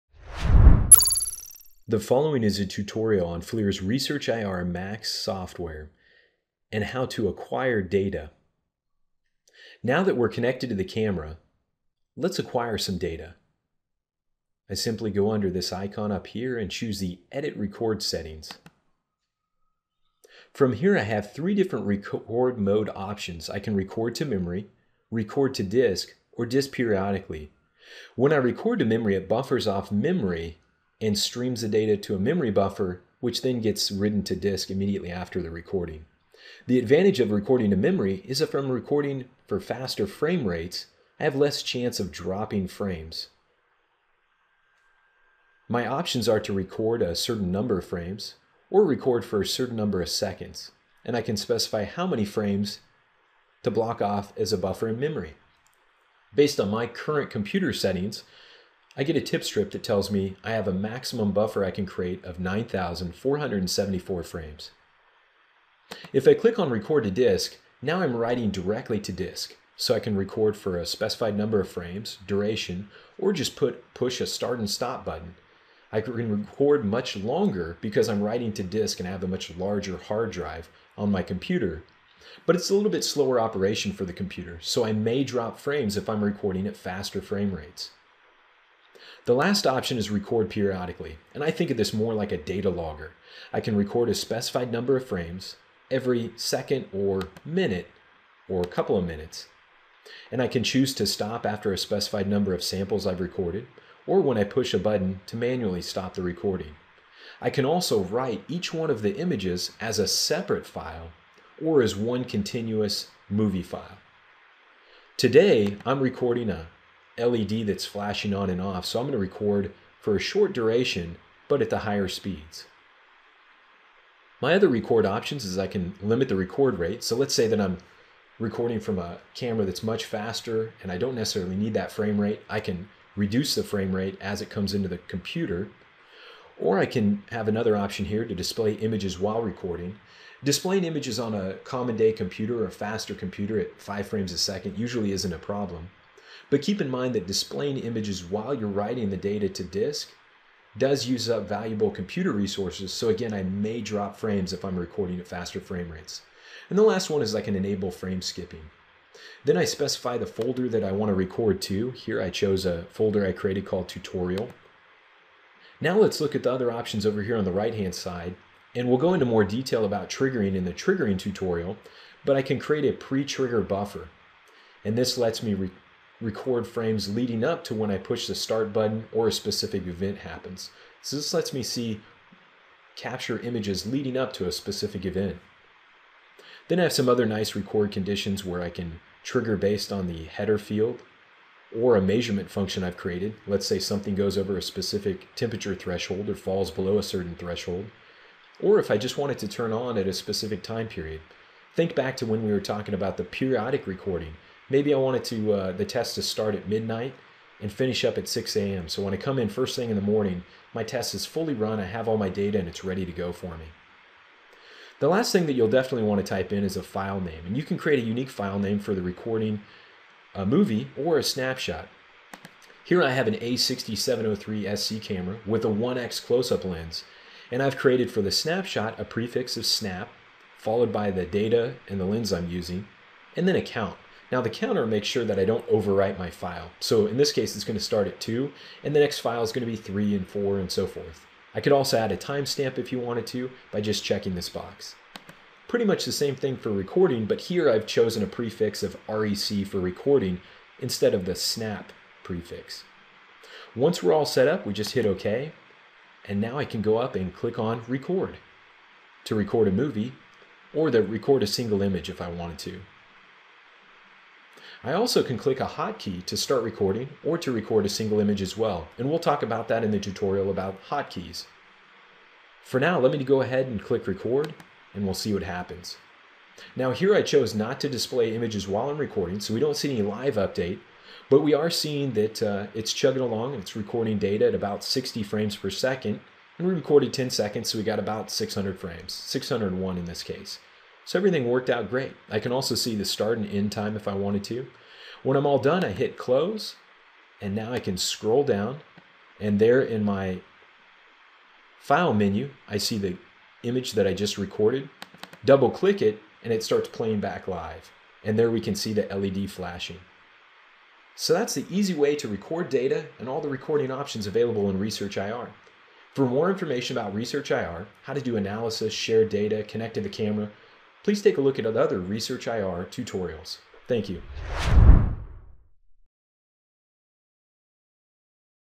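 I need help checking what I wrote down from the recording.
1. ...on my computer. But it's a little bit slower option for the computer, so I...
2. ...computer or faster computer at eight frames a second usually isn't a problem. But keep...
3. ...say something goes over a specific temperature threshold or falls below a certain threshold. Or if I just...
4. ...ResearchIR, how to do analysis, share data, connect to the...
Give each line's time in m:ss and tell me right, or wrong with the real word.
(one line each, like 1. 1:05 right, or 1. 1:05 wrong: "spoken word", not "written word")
1. 1:20 wrong: "operation", not "option"
2. 2:22 wrong: "five", not "eight"
3. 3:13 right
4. 5:17 right.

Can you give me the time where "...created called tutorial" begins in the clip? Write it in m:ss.
2:43.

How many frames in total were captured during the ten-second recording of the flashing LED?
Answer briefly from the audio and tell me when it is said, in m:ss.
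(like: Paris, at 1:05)
601, at 4:49.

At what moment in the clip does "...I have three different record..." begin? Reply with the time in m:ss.
0:20.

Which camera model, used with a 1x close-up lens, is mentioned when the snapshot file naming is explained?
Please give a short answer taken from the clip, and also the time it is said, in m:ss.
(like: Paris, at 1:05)
A6703 SC, at 3:43.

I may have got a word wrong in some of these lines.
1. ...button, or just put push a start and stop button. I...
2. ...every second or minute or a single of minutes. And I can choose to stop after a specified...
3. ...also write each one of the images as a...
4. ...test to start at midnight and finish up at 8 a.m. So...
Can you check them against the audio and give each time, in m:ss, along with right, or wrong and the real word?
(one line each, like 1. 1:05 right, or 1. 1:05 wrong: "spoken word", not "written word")
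1. 1:12 wrong: "duration", not "button"
2. 1:35 wrong: "couple", not "single"
3. 1:47 right
4. 3:25 wrong: "6", not "8".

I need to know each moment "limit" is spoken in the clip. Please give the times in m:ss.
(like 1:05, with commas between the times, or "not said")
2:06.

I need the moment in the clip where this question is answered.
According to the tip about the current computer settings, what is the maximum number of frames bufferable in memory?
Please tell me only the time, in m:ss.
1:02.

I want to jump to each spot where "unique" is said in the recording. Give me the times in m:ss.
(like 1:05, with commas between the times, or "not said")
3:38.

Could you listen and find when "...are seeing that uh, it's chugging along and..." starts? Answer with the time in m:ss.
4:41.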